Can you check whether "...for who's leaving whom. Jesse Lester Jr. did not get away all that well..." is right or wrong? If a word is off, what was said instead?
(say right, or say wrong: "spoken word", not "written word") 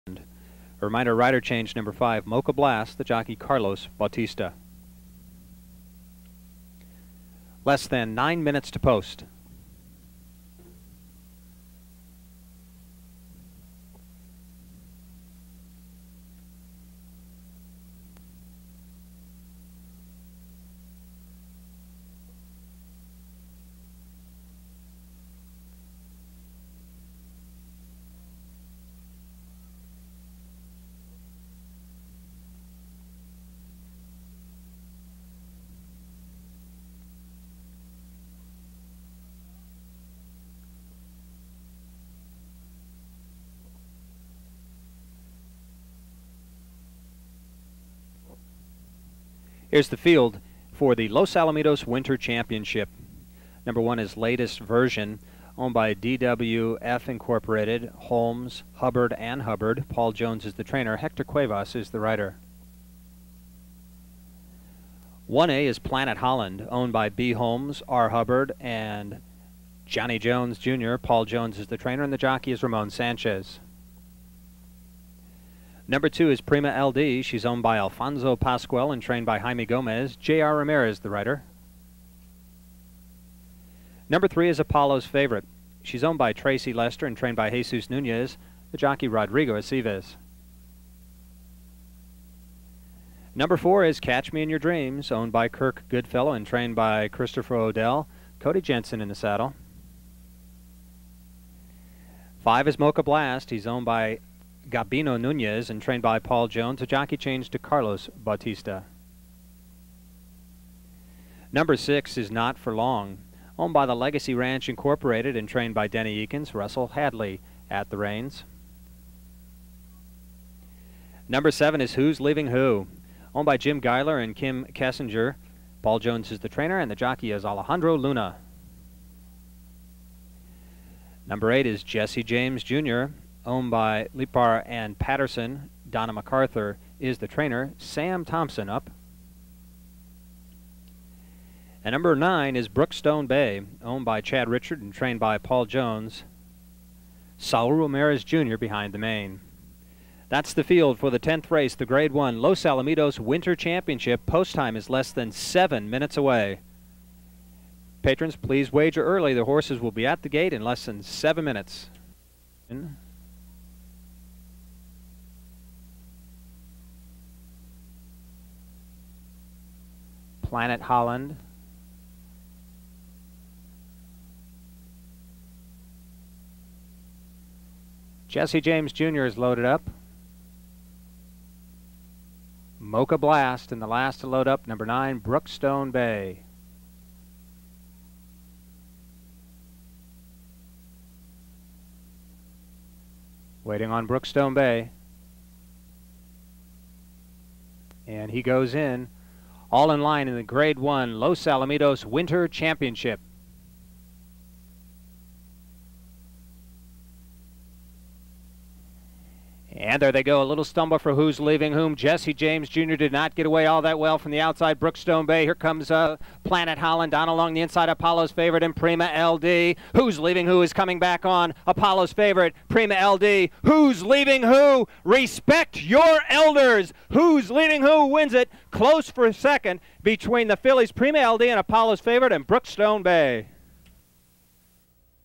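wrong: "James", not "Lester".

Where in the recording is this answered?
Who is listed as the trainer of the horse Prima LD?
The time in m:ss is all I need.
1:19.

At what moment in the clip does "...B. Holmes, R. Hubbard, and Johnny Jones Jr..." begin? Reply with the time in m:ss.
1:07.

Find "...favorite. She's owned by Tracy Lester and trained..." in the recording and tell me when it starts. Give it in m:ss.
1:25.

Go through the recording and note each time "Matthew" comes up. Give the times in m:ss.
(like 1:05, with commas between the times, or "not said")
not said.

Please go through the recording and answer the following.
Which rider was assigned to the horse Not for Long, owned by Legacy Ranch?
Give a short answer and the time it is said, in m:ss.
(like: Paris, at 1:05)
Russell Hadley, at 1:56.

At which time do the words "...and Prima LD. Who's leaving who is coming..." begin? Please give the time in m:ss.
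3:38.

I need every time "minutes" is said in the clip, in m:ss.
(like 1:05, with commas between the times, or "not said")
0:08, 2:35, 2:41.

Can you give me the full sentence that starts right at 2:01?
Number seven is Who's Leaving Who, owned by Jim Geiler and Kim Kessinger.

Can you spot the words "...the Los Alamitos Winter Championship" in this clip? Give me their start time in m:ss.
0:50.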